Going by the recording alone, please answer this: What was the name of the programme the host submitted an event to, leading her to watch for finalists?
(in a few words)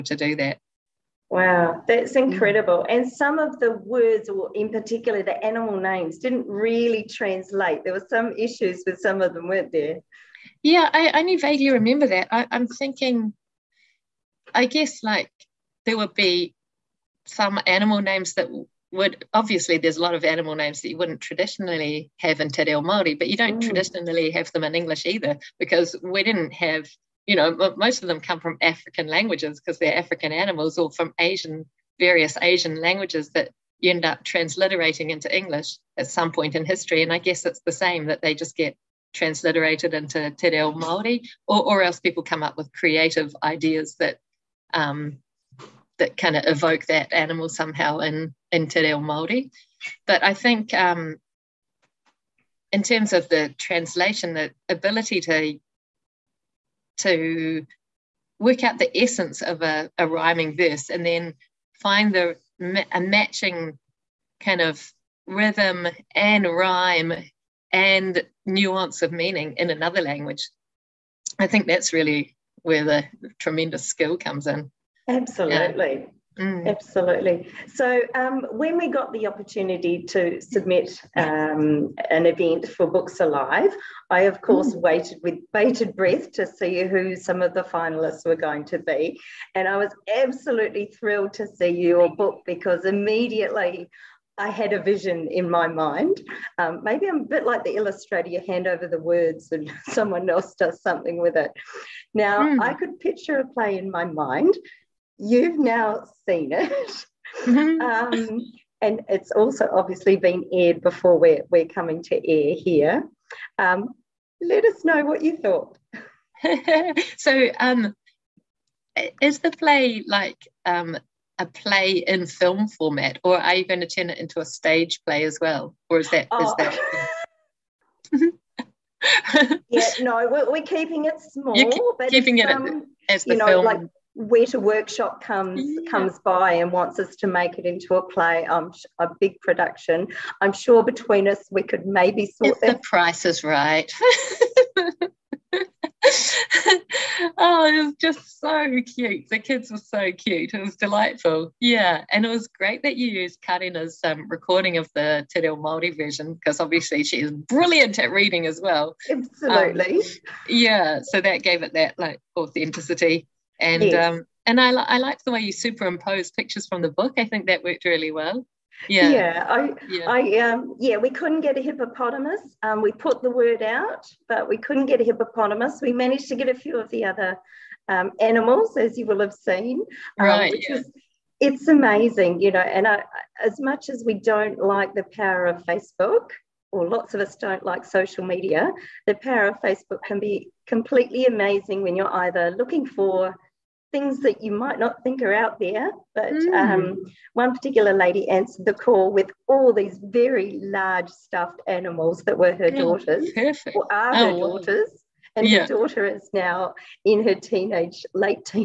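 Books Alive.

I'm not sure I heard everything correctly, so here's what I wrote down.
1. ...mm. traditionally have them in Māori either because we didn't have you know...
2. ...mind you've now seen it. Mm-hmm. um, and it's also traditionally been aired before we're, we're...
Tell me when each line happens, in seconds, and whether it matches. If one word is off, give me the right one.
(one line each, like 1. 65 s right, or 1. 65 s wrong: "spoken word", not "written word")
1. 23 s wrong: "English", not "Māori"
2. 104 s wrong: "obviously", not "traditionally".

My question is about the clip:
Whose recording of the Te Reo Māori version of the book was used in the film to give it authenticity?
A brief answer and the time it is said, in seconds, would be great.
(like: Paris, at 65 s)
Karina's, at 153 s.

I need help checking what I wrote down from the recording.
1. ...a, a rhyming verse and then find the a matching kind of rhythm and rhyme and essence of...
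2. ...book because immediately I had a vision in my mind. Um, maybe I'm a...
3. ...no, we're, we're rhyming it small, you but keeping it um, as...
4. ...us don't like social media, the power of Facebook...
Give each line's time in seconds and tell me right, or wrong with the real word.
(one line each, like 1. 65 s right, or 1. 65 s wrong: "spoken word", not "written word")
1. 59 s wrong: "nuance", not "essence"
2. 92 s right
3. 130 s wrong: "keeping", not "rhyming"
4. 187 s right.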